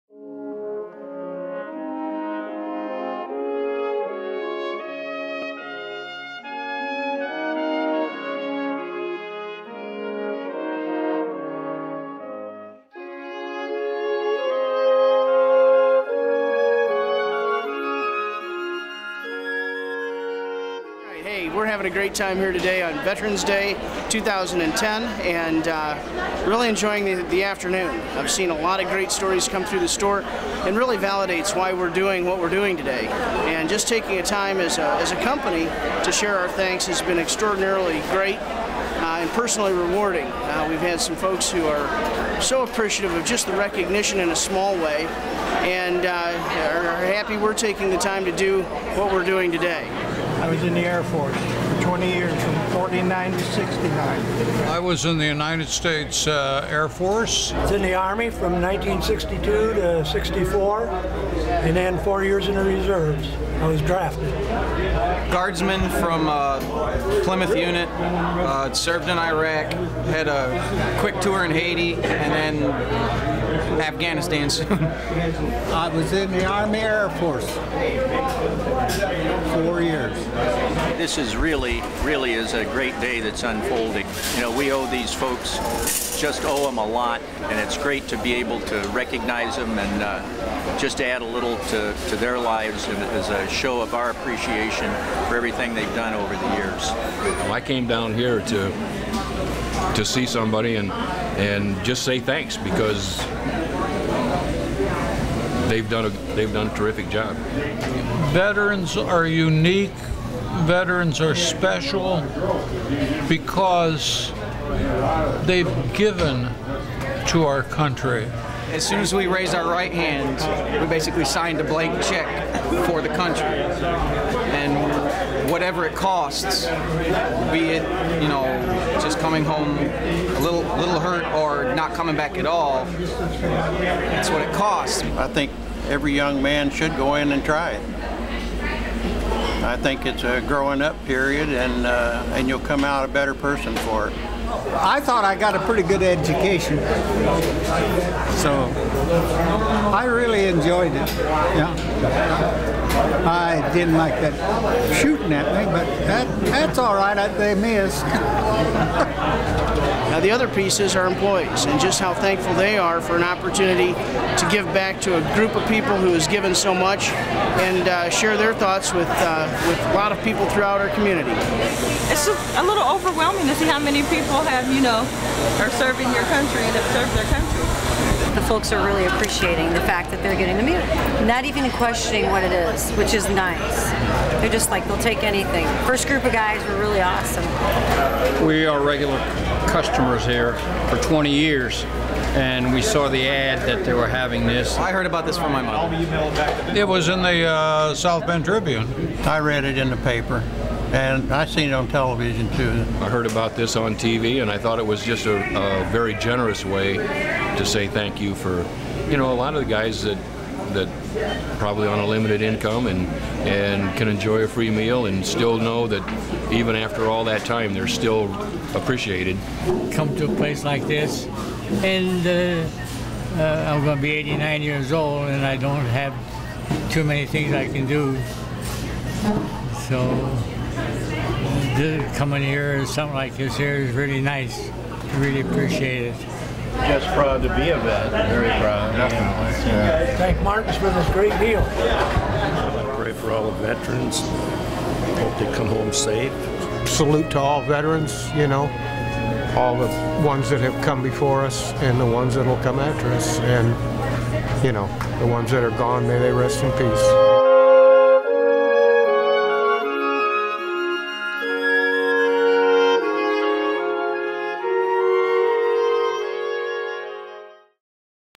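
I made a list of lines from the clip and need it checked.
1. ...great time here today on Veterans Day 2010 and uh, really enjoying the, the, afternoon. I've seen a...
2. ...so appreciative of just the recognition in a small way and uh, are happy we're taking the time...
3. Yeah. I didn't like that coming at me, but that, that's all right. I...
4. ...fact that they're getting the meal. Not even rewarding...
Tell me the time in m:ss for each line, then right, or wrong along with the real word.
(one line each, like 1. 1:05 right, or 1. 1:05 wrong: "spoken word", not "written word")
1. 0:21 right
2. 0:42 right
3. 2:31 wrong: "shooting", not "coming"
4. 2:59 wrong: "questioning", not "rewarding".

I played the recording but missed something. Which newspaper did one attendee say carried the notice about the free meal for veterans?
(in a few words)
South Bend Tribune.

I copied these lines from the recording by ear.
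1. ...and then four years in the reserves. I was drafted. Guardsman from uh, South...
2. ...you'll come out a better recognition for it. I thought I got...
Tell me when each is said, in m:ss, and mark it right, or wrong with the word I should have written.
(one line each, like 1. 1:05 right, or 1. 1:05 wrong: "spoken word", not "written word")
1. 1:00 wrong: "Plymouth", not "South"
2. 2:22 wrong: "person", not "recognition".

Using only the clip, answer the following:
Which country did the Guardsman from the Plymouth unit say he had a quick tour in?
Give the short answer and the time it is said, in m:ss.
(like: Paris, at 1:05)
Haiti, at 1:11.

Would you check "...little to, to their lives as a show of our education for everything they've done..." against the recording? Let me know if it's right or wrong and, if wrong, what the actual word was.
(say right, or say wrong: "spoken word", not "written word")
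wrong: "appreciation", not "education".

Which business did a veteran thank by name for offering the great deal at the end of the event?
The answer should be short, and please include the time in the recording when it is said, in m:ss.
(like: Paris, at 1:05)
Martin's, at 4:00.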